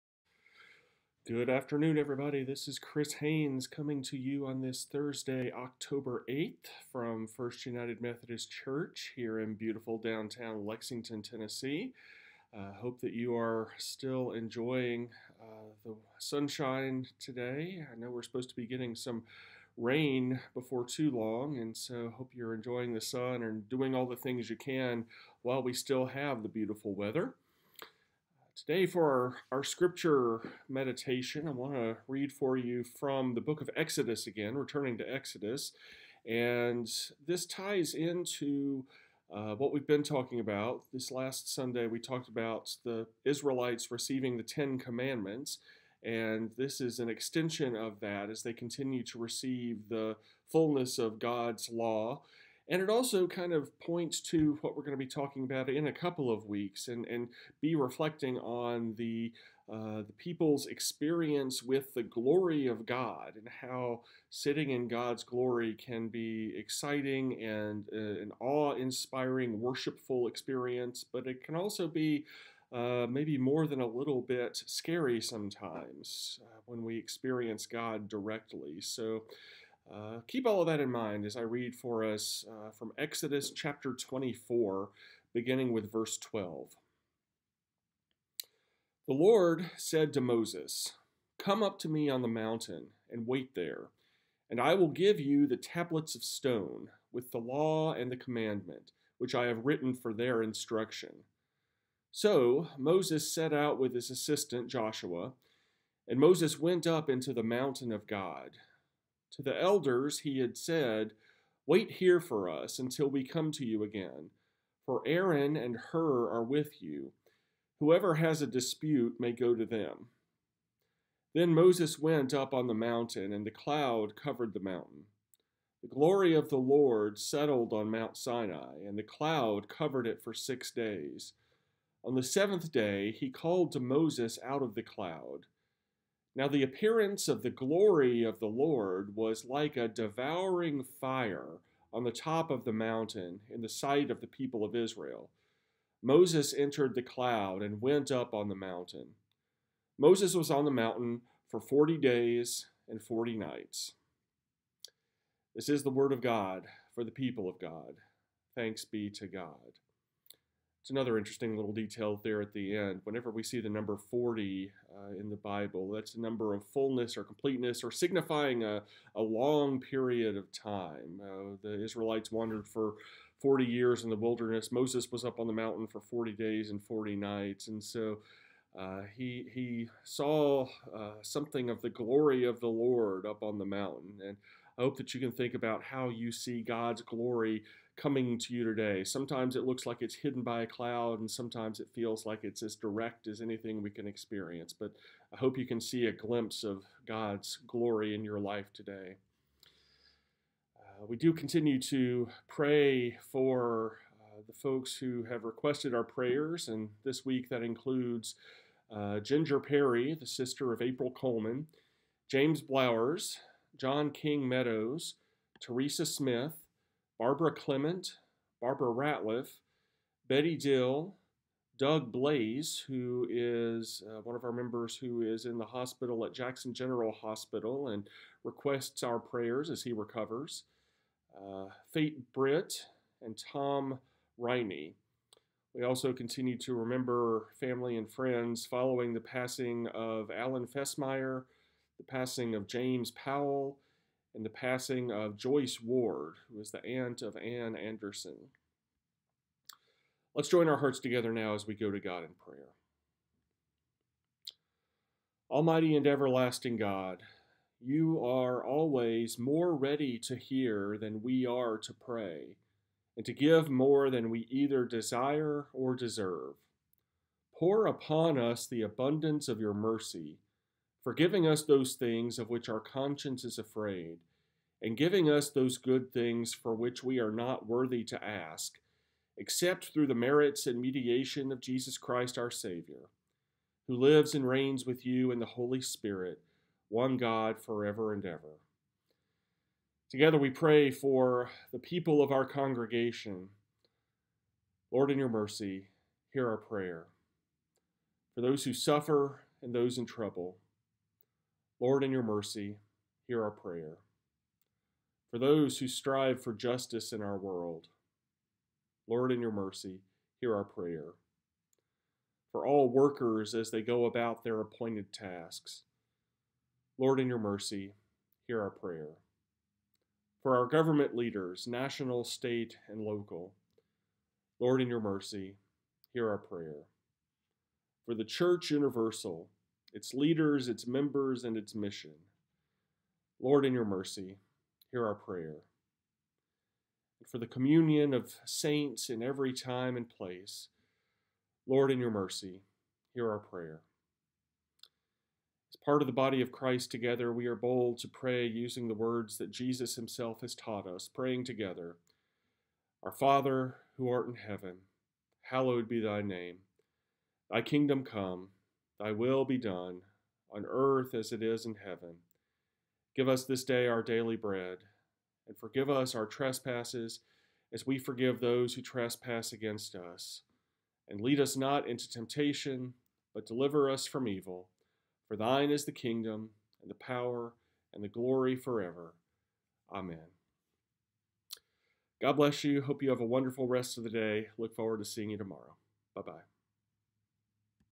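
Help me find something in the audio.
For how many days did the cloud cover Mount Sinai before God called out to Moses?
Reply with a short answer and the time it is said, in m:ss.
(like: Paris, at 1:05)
6, at 2:10.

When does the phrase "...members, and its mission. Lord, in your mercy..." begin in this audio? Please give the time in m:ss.
5:30.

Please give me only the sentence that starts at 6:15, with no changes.
For thine is the kingdom, and the power, and the glory forever.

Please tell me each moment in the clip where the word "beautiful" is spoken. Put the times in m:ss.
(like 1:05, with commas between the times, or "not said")
0:09, 0:26.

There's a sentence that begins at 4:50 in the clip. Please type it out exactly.
Together we pray for the people of our congregation.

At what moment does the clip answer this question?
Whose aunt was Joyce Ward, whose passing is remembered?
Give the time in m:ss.
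4:07.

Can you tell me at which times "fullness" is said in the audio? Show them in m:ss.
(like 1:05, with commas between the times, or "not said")
0:50, 2:46.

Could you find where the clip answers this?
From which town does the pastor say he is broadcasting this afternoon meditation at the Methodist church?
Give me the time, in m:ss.
0:10.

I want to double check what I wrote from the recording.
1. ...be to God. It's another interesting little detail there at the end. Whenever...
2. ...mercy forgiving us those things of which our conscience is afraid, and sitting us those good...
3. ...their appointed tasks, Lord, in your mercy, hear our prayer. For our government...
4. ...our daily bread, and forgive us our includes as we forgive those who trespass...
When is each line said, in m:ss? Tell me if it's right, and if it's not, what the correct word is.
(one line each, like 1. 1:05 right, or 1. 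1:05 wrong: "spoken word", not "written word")
1. 2:38 right
2. 4:29 wrong: "giving", not "sitting"
3. 5:14 right
4. 6:03 wrong: "trespasses", not "includes".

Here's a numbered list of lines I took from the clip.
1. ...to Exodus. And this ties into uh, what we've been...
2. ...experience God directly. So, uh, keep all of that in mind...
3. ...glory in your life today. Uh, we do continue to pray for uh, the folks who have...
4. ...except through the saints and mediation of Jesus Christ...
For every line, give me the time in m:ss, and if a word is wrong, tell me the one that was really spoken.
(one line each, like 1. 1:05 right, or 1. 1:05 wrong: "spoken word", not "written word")
1. 0:34 right
2. 1:16 right
3. 3:17 right
4. 4:39 wrong: "merits", not "saints".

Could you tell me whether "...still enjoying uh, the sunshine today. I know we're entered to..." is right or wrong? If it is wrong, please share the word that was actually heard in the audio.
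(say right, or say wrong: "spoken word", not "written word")
wrong: "supposed", not "entered".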